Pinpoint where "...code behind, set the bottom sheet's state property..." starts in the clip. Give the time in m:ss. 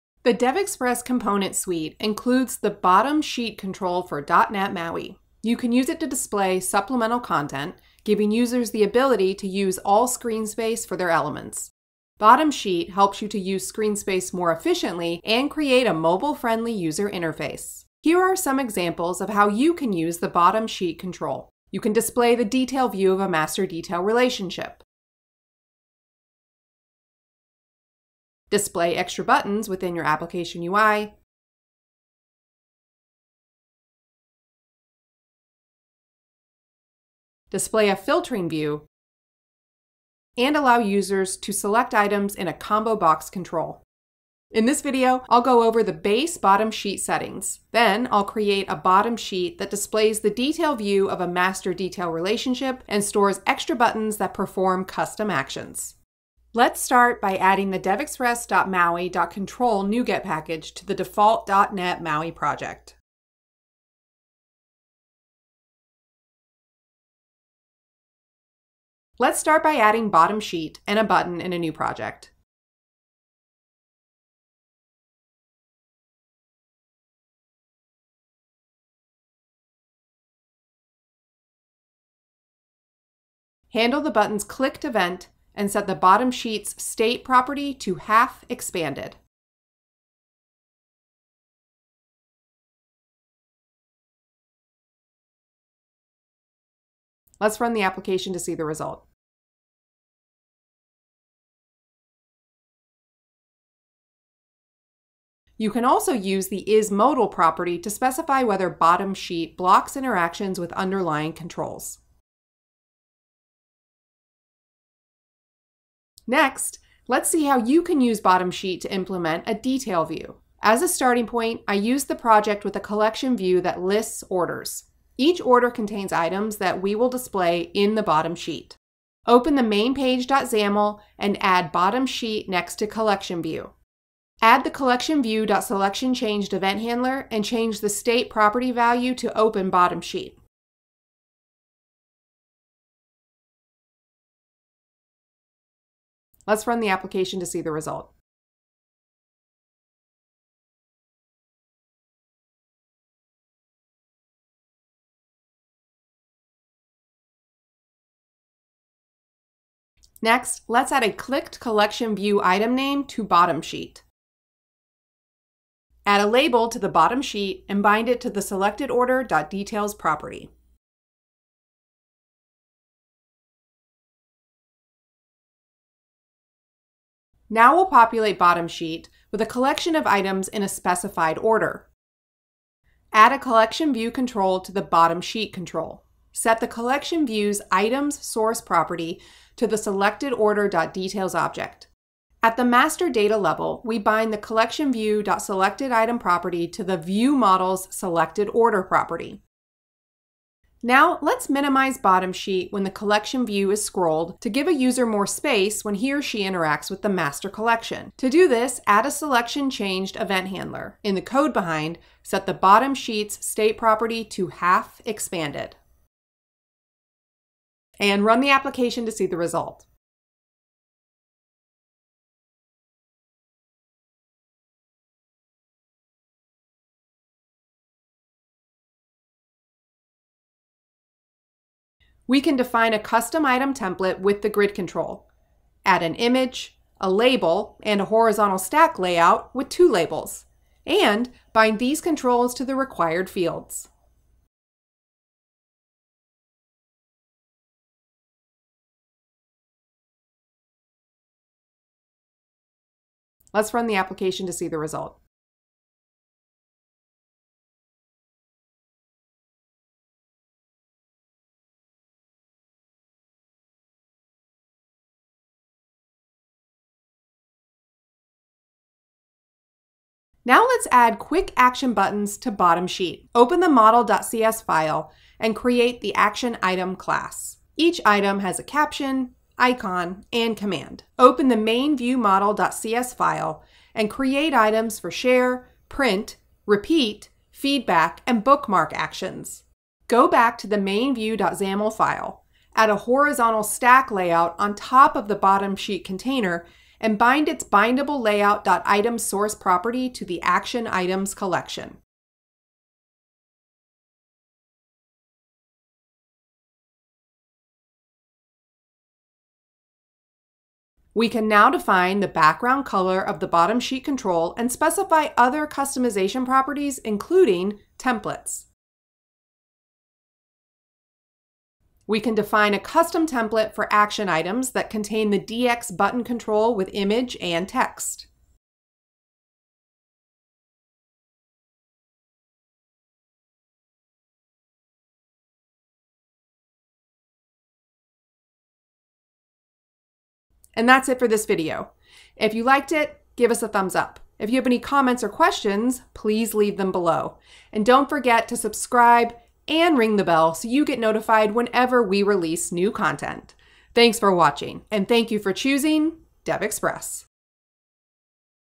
3:31.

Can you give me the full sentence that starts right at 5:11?
We can now define the background color of the bottom sheet control and specify other customization properties, including templates.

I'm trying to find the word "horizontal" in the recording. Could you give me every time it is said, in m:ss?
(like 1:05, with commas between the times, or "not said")
3:58, 4:52.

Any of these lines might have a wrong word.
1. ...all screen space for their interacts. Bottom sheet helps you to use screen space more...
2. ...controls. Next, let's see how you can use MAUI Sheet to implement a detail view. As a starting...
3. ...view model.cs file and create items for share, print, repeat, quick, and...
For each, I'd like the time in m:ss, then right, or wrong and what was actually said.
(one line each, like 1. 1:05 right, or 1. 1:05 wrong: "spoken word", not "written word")
1. 0:09 wrong: "elements", not "interacts"
2. 1:51 wrong: "Bottom", not "MAUI"
3. 4:41 wrong: "feedback", not "quick".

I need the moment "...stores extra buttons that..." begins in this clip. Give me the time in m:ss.
0:53.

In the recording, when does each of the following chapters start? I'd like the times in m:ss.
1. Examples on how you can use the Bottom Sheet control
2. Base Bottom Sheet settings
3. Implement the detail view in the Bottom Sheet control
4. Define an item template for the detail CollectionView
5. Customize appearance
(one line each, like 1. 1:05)
1. 0:19
2. 0:46
3. 1:55
4. 3:52
5. 5:11.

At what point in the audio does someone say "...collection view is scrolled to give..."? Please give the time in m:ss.
3:22.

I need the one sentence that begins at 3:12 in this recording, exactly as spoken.
At the master data level, we bind the collection view.selected item property to the view model's selected order property.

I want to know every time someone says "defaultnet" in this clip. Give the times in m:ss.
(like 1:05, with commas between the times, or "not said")
1:00.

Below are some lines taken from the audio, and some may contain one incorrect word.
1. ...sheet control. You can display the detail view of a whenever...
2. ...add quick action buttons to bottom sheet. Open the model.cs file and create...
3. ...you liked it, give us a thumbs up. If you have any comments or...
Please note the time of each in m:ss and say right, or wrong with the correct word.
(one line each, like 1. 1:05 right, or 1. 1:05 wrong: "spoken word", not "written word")
1. 0:20 wrong: "master", not "whenever"
2. 4:30 right
3. 5:42 right.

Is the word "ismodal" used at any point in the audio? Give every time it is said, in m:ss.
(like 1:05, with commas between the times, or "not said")
1:46.